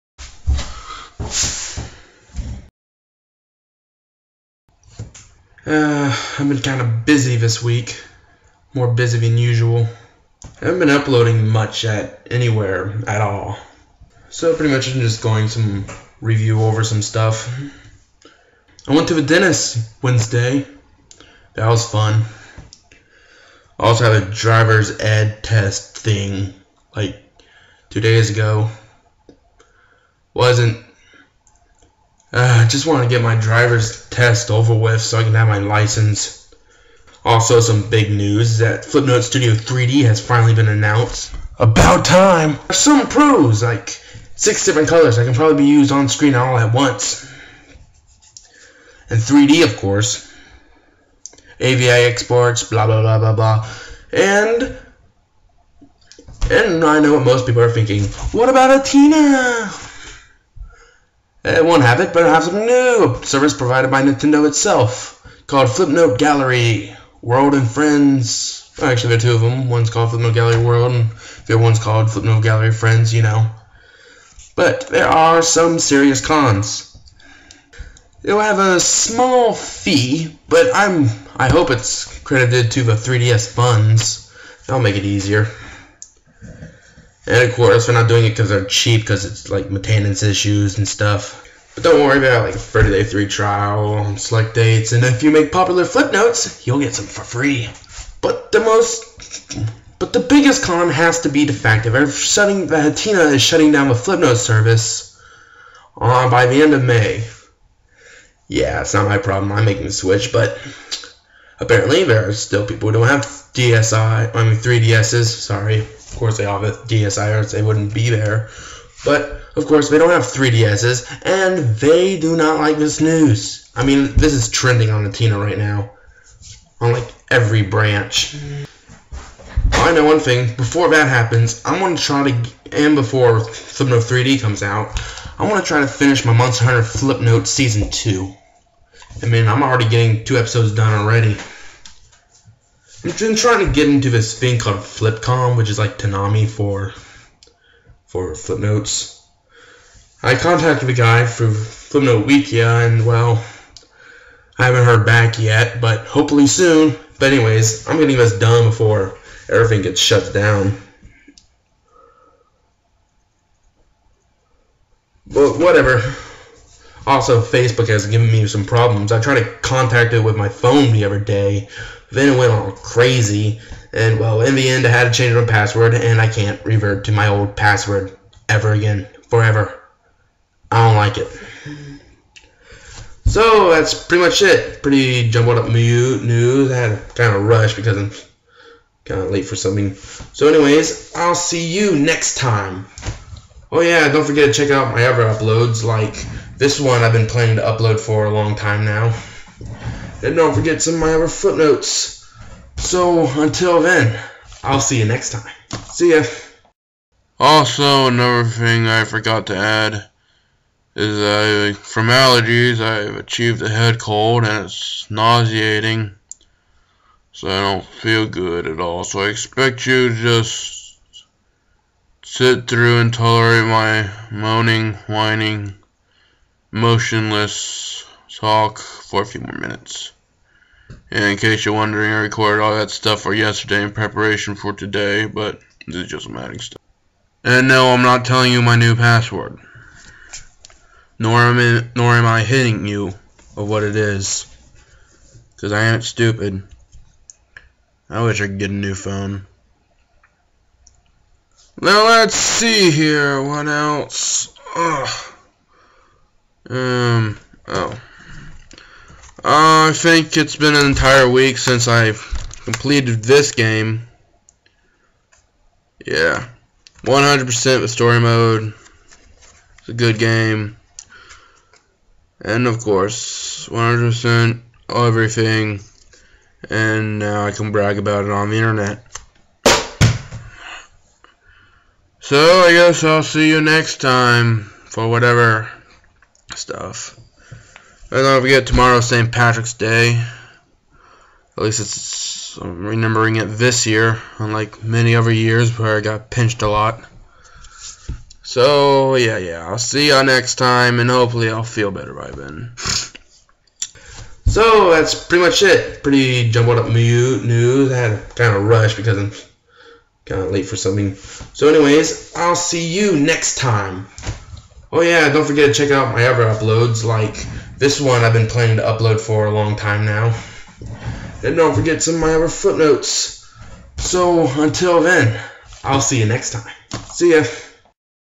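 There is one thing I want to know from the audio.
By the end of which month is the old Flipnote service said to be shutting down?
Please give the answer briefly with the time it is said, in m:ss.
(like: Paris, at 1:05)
May, at 1:46.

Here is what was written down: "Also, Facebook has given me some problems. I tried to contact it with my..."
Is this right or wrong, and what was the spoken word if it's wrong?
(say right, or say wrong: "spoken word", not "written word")
right.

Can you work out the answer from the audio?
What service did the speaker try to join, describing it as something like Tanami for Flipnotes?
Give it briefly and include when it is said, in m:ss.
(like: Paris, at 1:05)
Flipcom, at 2:24.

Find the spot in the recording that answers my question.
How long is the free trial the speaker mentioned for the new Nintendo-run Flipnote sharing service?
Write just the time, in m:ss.
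1:32.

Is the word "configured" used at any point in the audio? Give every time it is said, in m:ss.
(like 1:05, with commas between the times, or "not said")
not said.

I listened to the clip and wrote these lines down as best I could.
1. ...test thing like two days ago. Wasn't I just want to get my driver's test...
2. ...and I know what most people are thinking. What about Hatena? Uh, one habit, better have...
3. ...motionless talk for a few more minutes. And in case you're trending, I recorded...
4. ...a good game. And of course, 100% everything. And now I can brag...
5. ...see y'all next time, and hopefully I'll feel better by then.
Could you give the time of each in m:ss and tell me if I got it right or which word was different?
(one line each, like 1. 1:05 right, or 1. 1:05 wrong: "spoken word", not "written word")
1. 0:25 right
2. 0:56 right
3. 3:46 wrong: "wondering", not "trending"
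4. 4:29 right
5. 4:59 right.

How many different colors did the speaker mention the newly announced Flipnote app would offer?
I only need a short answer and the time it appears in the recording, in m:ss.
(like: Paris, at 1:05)
6, at 0:44.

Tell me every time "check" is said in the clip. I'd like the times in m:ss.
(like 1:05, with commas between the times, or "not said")
3:14, 5:15.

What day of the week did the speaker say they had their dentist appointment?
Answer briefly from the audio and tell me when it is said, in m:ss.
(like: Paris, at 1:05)
Wednesday, at 0:20.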